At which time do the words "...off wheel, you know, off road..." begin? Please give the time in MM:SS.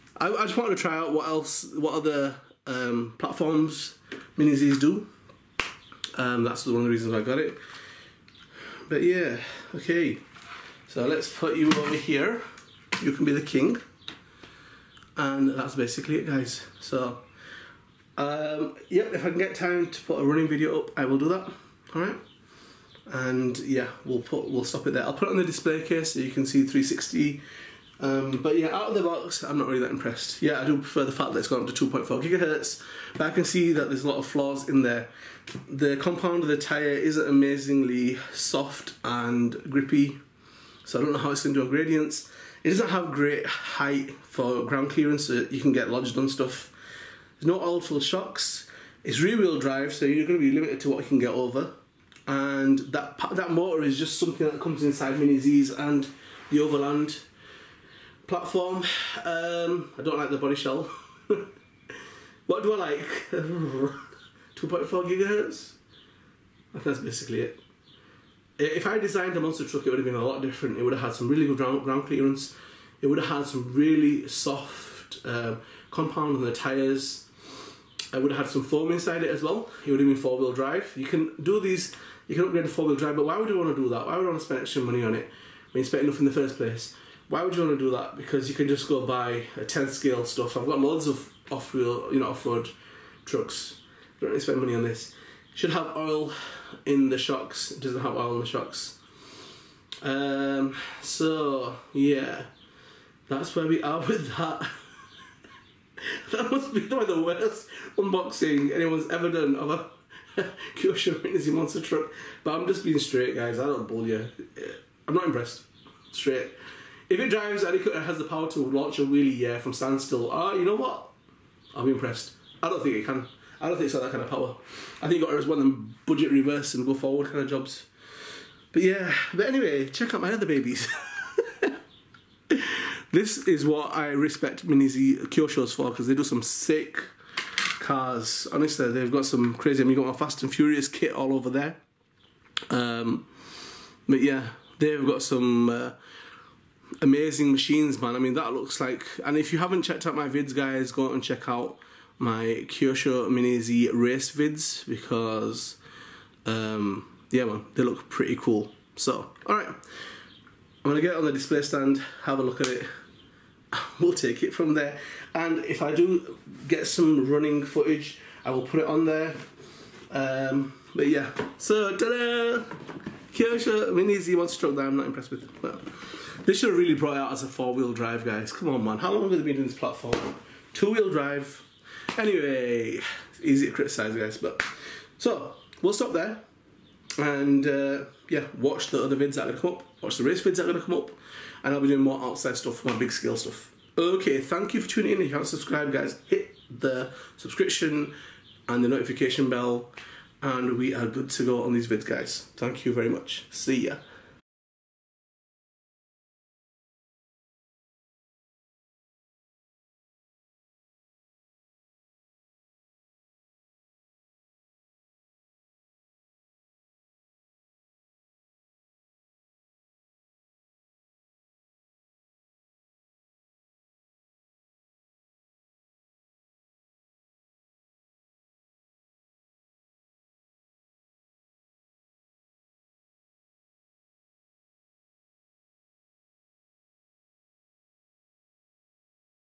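01:31.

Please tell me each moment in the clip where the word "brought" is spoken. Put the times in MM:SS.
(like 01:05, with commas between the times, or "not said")
02:56.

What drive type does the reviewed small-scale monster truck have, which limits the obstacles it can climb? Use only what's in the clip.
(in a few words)
rear wheel drive.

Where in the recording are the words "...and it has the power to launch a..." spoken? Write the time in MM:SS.
01:57.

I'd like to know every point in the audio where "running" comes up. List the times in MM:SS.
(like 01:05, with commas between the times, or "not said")
00:20, 02:47.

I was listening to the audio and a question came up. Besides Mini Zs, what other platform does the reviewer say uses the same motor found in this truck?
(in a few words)
Overland.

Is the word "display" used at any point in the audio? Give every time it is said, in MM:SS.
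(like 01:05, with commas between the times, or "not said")
00:25, 02:41.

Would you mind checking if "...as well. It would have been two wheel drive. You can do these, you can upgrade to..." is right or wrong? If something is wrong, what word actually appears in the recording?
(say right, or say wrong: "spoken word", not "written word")
wrong: "four", not "two".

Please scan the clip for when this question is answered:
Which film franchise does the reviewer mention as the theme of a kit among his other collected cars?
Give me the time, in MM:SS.
02:20.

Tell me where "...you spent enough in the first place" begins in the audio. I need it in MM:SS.
01:25.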